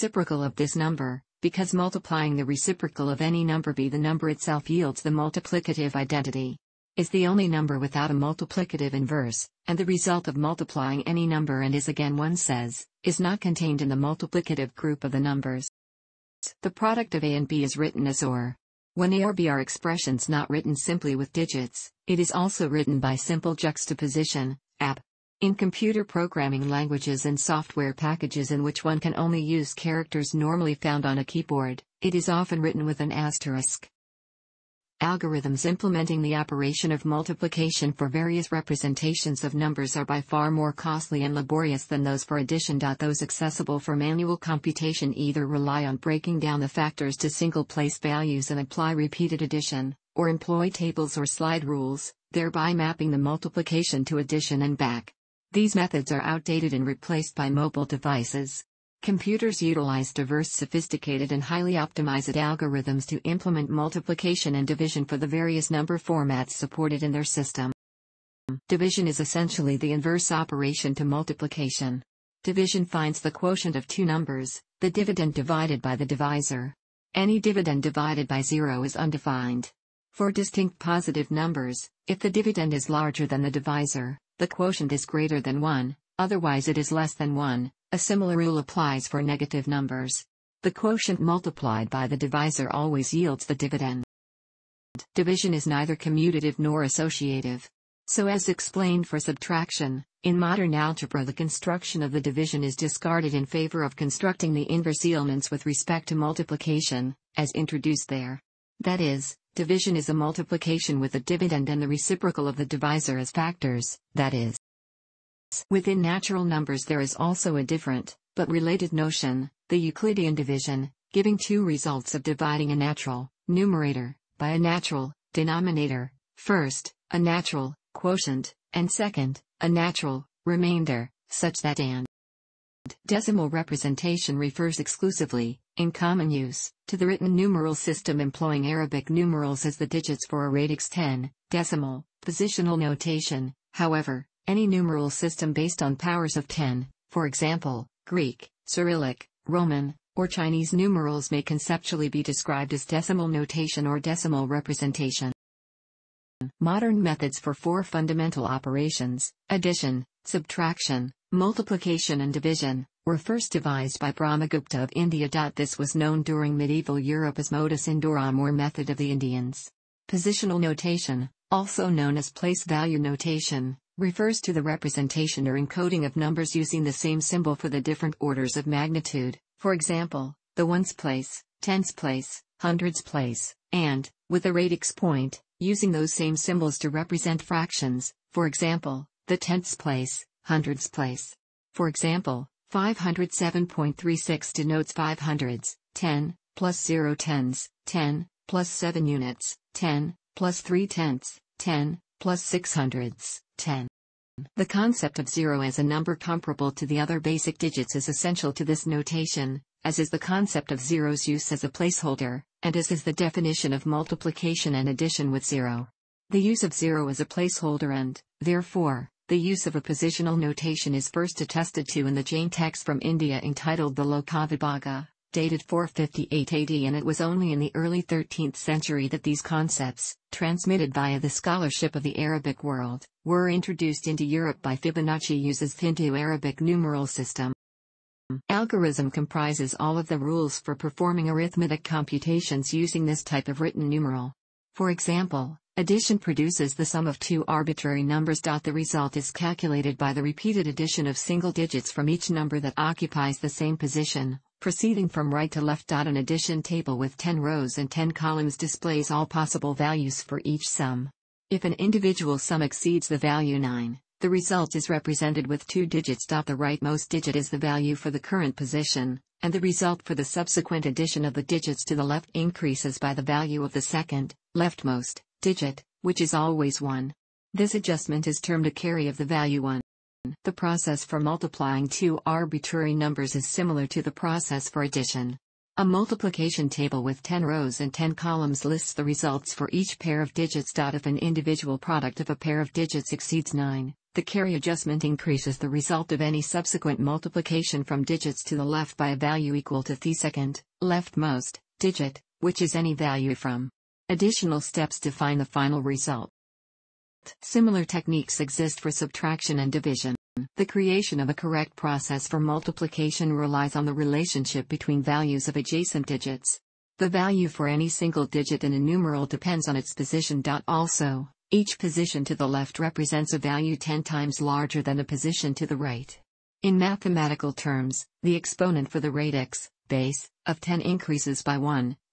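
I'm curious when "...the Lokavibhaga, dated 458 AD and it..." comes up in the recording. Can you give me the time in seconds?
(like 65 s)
223 s.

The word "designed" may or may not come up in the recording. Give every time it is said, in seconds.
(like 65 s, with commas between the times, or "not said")
not said.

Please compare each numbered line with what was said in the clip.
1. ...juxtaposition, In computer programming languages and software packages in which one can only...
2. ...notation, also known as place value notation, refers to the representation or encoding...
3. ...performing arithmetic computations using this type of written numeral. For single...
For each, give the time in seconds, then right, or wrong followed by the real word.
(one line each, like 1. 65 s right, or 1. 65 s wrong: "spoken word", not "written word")
1. 23 s right
2. 170 s right
3. 240 s wrong: "example", not "single".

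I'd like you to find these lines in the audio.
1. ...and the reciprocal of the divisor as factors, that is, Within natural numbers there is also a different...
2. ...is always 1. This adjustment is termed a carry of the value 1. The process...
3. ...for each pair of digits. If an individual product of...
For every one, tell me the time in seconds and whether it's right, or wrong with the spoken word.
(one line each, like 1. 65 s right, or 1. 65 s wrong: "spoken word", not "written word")
1. 111 s right
2. 276 s right
3. 289 s right.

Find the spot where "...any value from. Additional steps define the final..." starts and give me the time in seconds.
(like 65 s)
302 s.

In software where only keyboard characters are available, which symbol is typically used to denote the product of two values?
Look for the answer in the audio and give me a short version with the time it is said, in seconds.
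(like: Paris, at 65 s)
asterisk, at 33 s.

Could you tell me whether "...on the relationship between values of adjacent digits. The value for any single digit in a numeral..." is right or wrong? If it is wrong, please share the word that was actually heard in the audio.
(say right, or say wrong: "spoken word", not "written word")
right.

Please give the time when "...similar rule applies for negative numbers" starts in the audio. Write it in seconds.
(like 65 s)
87 s.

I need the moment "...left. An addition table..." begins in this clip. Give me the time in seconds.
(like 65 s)
255 s.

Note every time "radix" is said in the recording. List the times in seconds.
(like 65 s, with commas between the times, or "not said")
140 s, 184 s, 329 s.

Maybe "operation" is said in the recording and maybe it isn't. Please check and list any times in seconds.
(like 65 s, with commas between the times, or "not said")
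36 s, 70 s, 158 s.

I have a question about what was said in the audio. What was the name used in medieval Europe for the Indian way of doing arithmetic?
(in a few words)
modus indorum.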